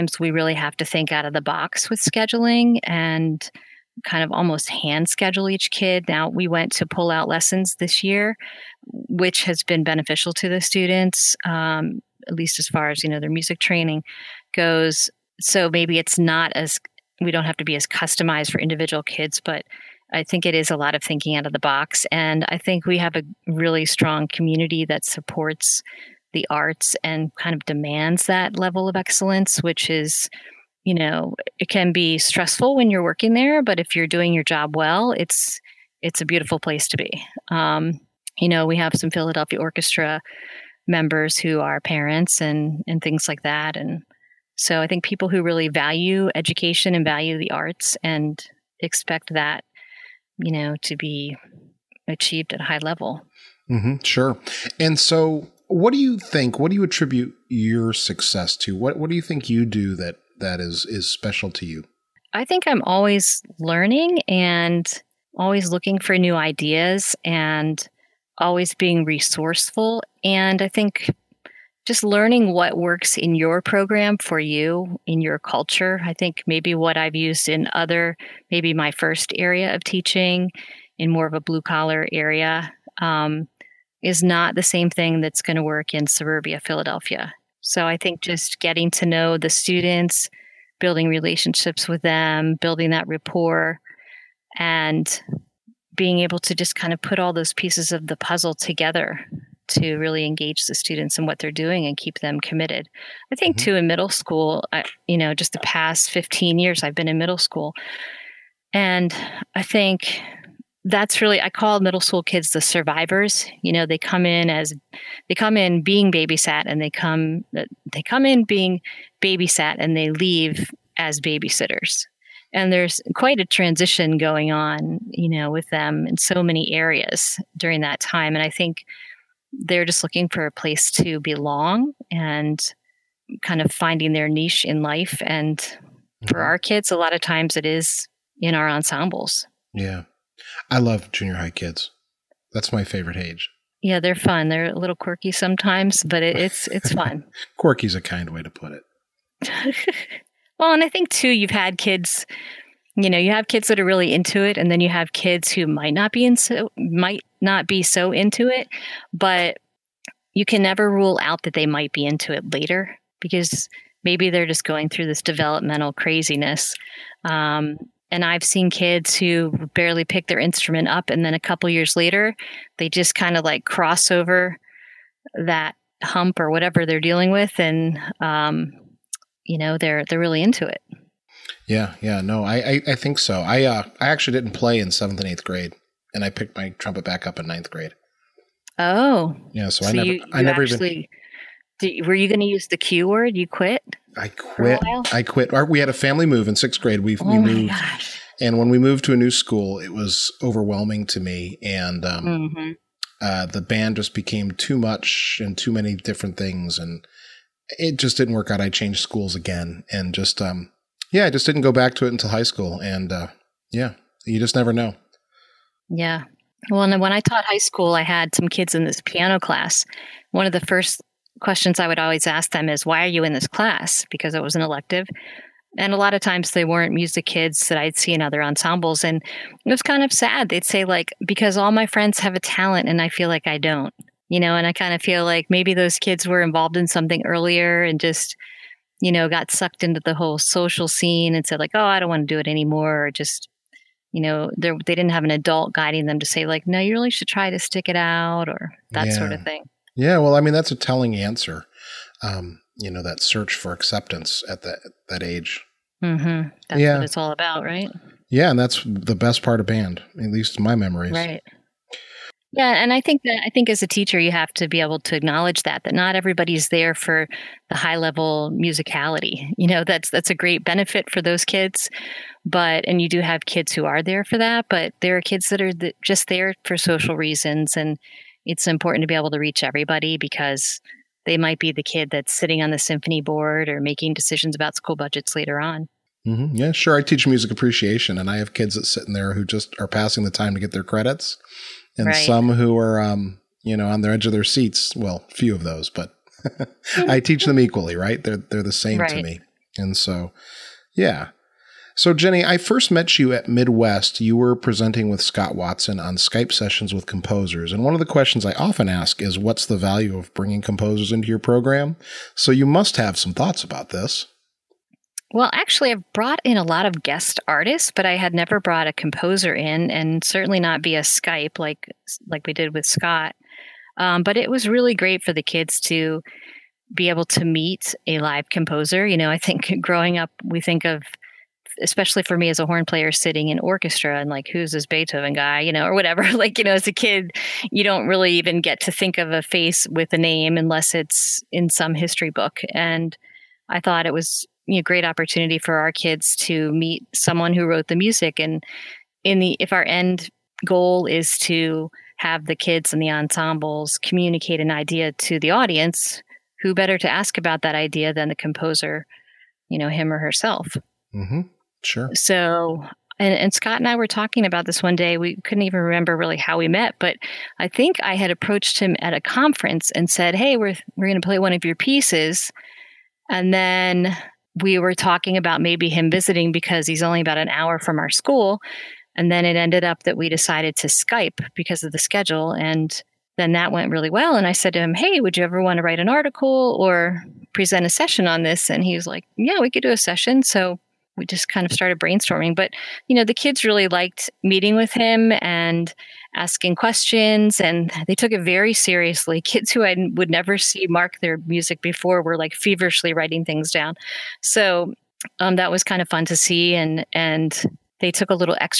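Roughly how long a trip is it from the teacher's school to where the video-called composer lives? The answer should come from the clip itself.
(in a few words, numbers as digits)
About an hour.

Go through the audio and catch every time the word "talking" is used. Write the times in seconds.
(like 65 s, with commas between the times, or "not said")
364 s, 374 s.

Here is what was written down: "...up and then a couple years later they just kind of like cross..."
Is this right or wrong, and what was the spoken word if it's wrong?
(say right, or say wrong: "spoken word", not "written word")
right.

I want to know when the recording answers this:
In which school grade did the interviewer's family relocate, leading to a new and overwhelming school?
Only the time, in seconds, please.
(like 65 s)
196 s.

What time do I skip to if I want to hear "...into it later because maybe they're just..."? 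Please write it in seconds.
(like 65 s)
162 s.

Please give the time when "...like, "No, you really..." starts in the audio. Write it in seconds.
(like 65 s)
246 s.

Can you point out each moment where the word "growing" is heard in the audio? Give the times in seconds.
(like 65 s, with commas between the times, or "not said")
329 s.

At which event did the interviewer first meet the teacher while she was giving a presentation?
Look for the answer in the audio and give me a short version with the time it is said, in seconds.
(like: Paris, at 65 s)
Midwest, at 303 s.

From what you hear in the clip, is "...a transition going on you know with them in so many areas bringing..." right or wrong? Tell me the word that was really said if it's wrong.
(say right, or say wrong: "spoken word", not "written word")
wrong: "during", not "bringing".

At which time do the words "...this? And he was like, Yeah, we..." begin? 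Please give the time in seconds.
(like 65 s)
388 s.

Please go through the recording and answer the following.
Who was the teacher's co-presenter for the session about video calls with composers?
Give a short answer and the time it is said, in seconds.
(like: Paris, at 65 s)
Scott Watson, at 305 s.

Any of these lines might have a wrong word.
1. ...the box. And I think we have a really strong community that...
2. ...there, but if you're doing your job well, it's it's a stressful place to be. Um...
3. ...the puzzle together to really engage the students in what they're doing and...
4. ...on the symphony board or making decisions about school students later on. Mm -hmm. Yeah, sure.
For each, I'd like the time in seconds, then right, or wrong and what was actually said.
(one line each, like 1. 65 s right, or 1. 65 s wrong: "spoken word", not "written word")
1. 21 s right
2. 33 s wrong: "beautiful", not "stressful"
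3. 98 s right
4. 282 s wrong: "budgets", not "students".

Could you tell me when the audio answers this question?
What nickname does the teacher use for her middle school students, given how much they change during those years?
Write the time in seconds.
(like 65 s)
112 s.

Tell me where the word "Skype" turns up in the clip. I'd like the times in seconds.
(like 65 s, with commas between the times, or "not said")
306 s, 321 s, 380 s.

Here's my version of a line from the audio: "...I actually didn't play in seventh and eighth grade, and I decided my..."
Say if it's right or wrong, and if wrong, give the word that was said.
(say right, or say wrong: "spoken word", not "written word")
wrong: "picked", not "decided".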